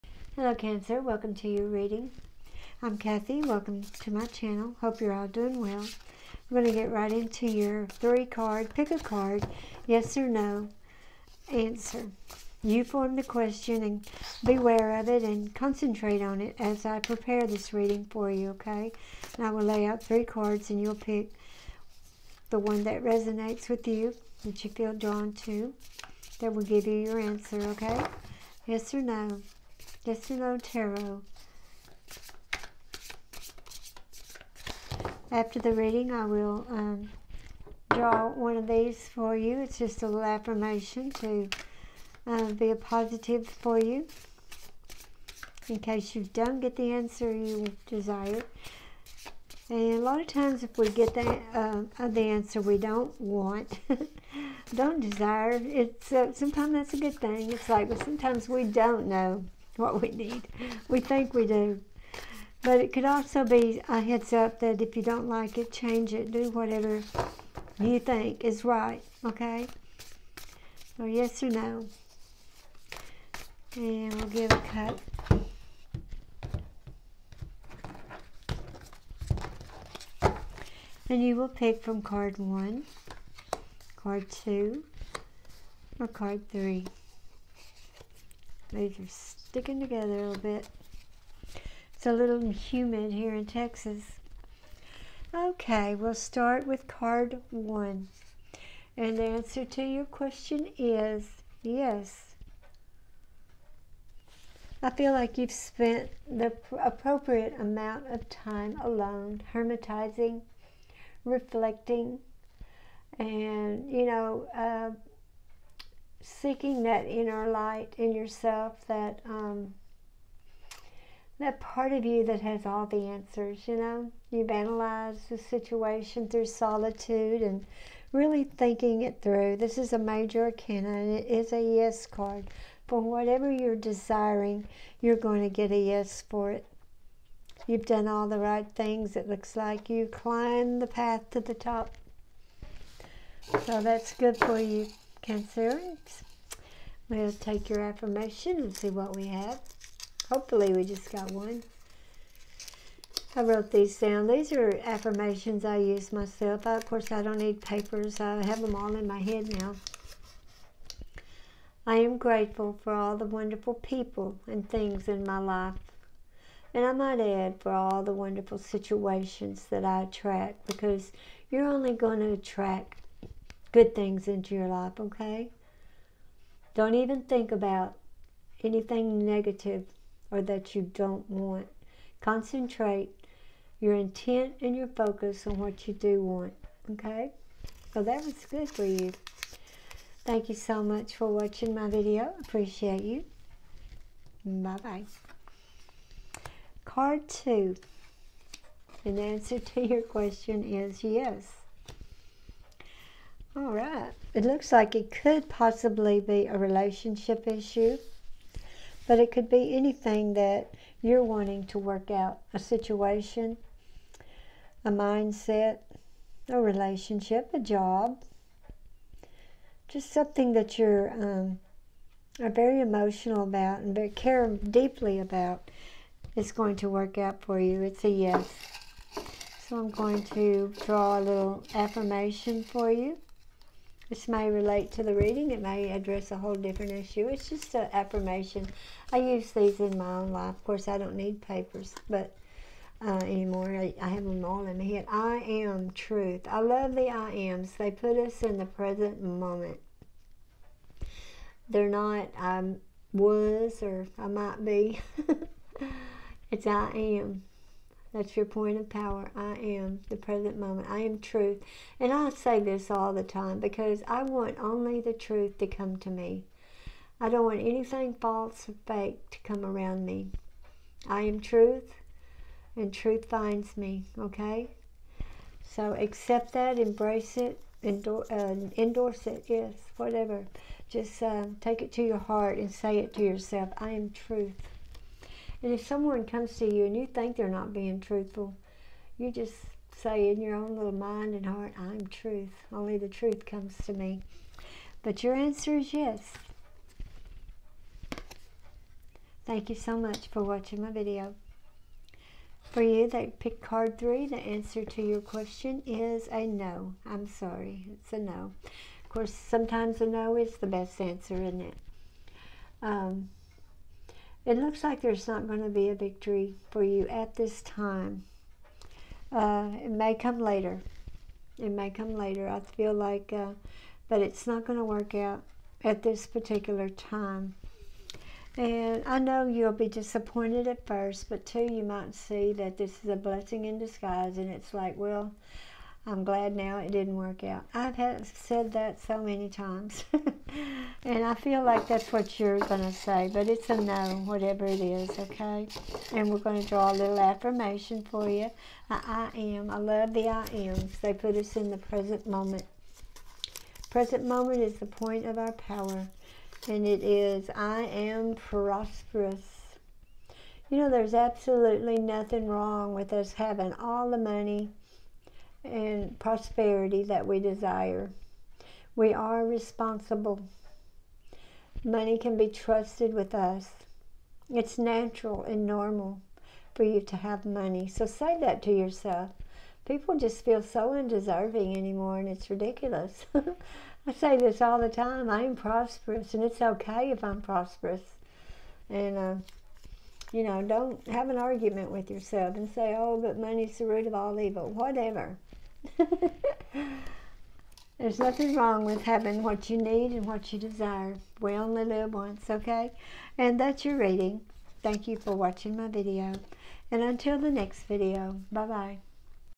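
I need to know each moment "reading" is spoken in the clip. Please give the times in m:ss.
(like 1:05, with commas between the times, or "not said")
0:01, 0:17, 0:35, 3:55, 6:43.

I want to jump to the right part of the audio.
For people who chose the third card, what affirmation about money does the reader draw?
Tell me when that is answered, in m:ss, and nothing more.
5:57.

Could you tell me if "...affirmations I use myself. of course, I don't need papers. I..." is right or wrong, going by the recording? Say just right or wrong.
right.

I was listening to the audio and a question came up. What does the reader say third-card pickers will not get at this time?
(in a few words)
a victory.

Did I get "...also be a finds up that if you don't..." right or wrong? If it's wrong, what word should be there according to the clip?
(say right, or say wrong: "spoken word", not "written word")
wrong: "heads", not "finds".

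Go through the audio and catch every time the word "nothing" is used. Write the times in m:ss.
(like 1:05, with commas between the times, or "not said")
6:01, 6:38.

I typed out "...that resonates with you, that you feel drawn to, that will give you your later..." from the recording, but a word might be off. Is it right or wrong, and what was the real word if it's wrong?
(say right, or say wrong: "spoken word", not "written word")
wrong: "answer", not "later".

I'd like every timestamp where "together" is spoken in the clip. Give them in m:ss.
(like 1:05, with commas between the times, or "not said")
1:29.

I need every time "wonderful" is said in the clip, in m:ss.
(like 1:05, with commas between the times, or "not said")
2:43, 2:48.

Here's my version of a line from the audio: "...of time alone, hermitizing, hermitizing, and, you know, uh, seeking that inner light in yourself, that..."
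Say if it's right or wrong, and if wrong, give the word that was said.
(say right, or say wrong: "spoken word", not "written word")
wrong: "reflecting", not "hermitizing".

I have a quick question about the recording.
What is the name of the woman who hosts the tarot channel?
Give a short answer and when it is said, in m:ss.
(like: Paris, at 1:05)
Kathy, at 0:02.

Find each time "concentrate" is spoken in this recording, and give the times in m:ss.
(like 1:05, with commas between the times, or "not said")
0:15, 3:02.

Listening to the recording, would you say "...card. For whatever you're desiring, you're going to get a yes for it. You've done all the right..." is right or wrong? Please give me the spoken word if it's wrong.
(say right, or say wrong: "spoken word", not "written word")
right.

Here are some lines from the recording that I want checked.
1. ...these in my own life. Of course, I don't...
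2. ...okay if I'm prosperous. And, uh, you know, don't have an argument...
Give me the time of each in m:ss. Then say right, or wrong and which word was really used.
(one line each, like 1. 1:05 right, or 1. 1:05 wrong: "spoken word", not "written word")
1. 3:59 right
2. 6:26 right.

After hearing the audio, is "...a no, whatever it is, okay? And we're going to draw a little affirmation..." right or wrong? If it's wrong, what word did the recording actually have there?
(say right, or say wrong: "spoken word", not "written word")
right.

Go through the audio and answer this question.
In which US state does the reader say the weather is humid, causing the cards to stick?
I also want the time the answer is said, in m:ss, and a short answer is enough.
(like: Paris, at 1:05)
Texas, at 1:33.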